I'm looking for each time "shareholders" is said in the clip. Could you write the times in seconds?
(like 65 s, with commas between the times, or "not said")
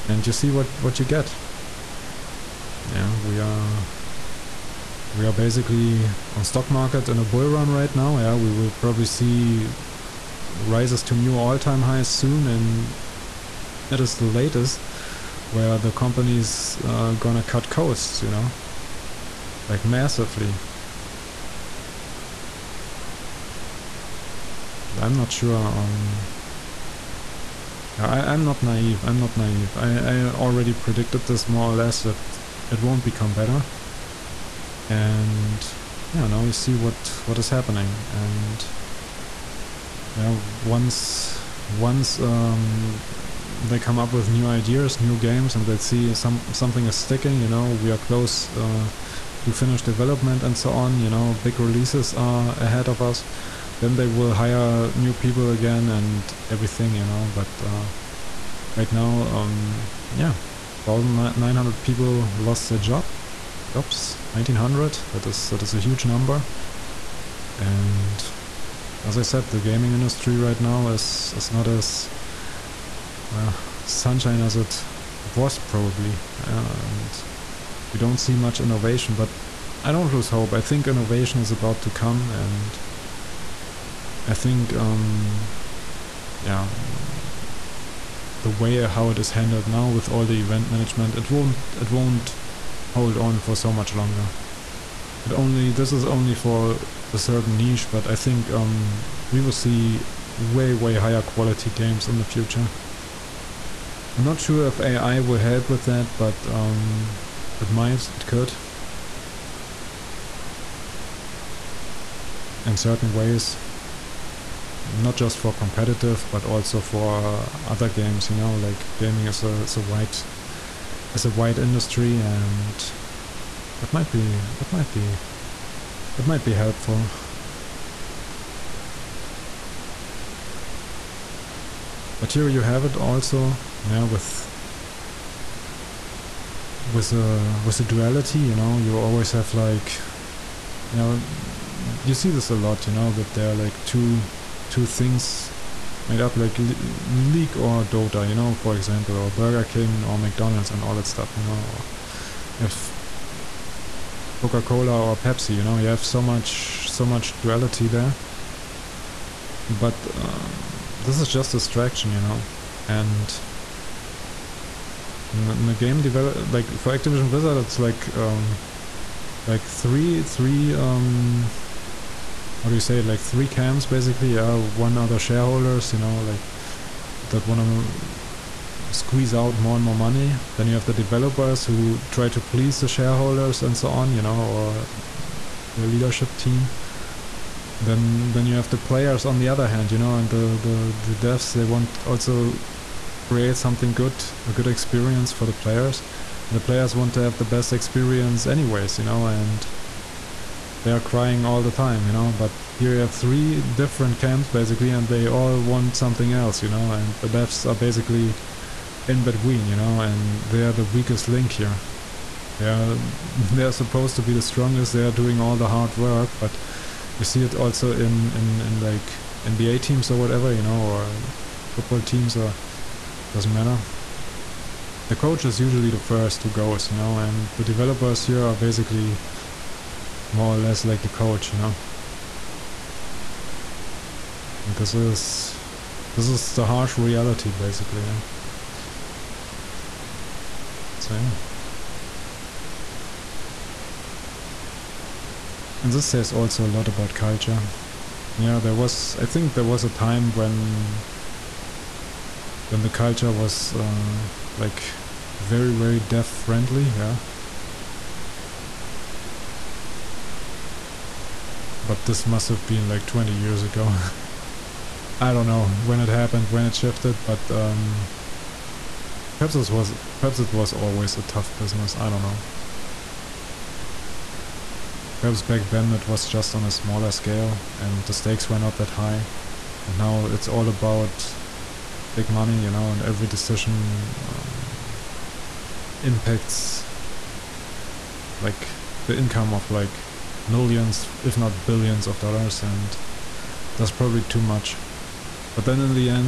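175 s, 182 s.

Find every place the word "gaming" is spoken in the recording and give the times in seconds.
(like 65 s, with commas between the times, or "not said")
69 s, 118 s.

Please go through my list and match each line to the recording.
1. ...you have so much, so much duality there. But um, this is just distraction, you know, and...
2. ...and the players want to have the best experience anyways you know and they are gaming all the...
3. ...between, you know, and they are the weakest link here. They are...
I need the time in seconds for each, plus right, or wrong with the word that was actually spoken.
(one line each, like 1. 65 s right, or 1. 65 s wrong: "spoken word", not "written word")
1. 155 s right
2. 196 s wrong: "crying", not "gaming"
3. 209 s right.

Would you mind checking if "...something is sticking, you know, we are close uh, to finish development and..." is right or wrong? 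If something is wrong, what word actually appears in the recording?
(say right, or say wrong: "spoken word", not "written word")
right.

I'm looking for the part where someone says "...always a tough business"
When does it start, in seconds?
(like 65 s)
270 s.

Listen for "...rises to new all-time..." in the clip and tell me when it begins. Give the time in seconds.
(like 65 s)
10 s.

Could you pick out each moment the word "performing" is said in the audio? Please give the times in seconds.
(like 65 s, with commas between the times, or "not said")
not said.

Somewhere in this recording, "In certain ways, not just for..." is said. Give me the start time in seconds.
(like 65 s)
112 s.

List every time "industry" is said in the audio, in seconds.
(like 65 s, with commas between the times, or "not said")
69 s, 121 s.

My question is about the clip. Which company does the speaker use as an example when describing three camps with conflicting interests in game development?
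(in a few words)
Activision Blizzard.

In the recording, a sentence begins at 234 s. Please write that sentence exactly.
And this is this is the harsh reality basically, yeah.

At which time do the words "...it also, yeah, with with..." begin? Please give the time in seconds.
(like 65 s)
132 s.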